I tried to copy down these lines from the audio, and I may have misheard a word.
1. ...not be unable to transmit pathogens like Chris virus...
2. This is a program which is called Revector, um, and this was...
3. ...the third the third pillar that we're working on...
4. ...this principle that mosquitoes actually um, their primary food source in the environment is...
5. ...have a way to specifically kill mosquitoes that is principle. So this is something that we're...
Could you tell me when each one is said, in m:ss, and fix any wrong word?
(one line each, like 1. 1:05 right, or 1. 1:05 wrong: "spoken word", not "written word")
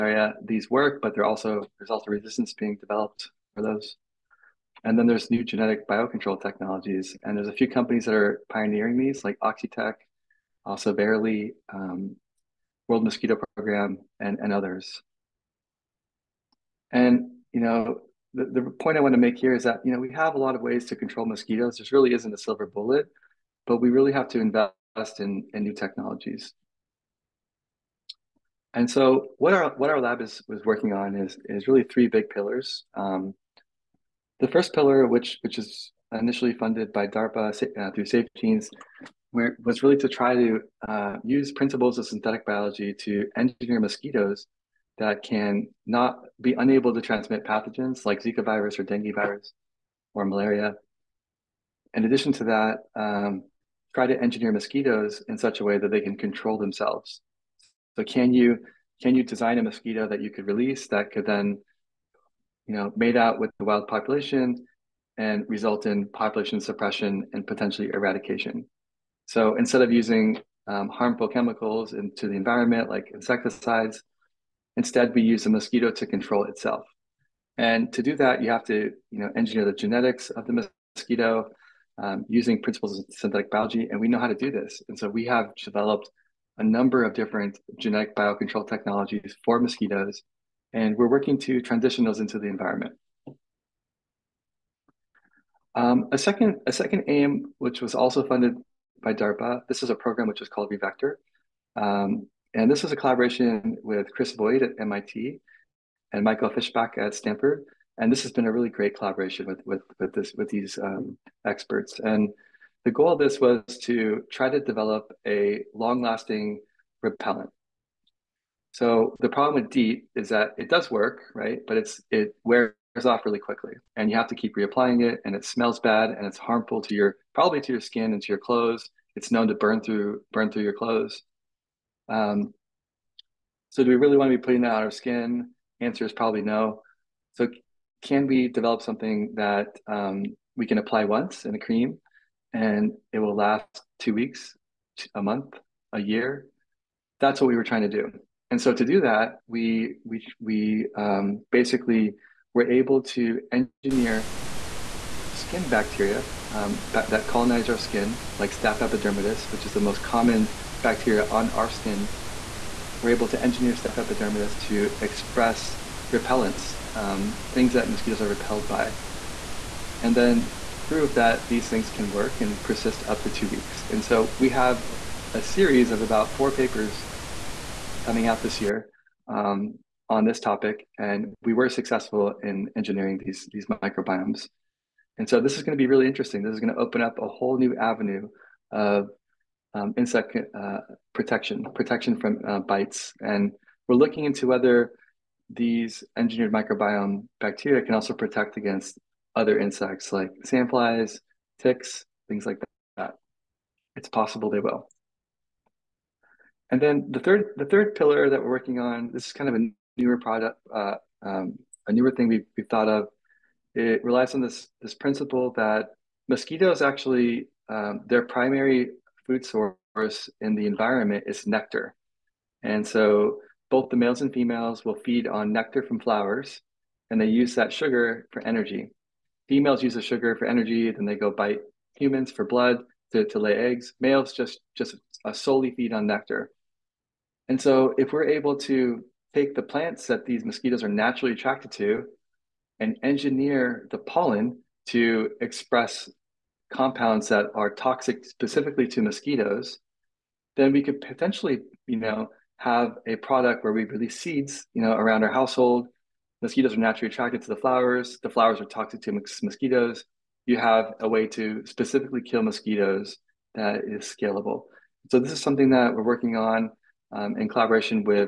1. 0:45 wrong: "Zika", not "Chris"
2. 1:39 right
3. 3:27 right
4. 3:34 right
5. 4:20 wrong: "scalable", not "principle".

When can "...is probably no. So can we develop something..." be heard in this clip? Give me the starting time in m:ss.
2:16.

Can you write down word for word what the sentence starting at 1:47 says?
And this has been a really great collaboration with with with this with these um, experts.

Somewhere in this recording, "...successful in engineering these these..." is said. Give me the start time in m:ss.
3:01.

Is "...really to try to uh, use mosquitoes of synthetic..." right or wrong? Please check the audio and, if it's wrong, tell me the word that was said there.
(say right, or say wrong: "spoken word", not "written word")
wrong: "principles", not "mosquitoes".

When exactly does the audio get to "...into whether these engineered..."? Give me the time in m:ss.
3:14.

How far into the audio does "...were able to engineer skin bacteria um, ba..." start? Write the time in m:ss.
2:32.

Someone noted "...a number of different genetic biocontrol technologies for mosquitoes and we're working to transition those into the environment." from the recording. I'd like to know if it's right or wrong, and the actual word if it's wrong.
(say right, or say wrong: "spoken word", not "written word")
right.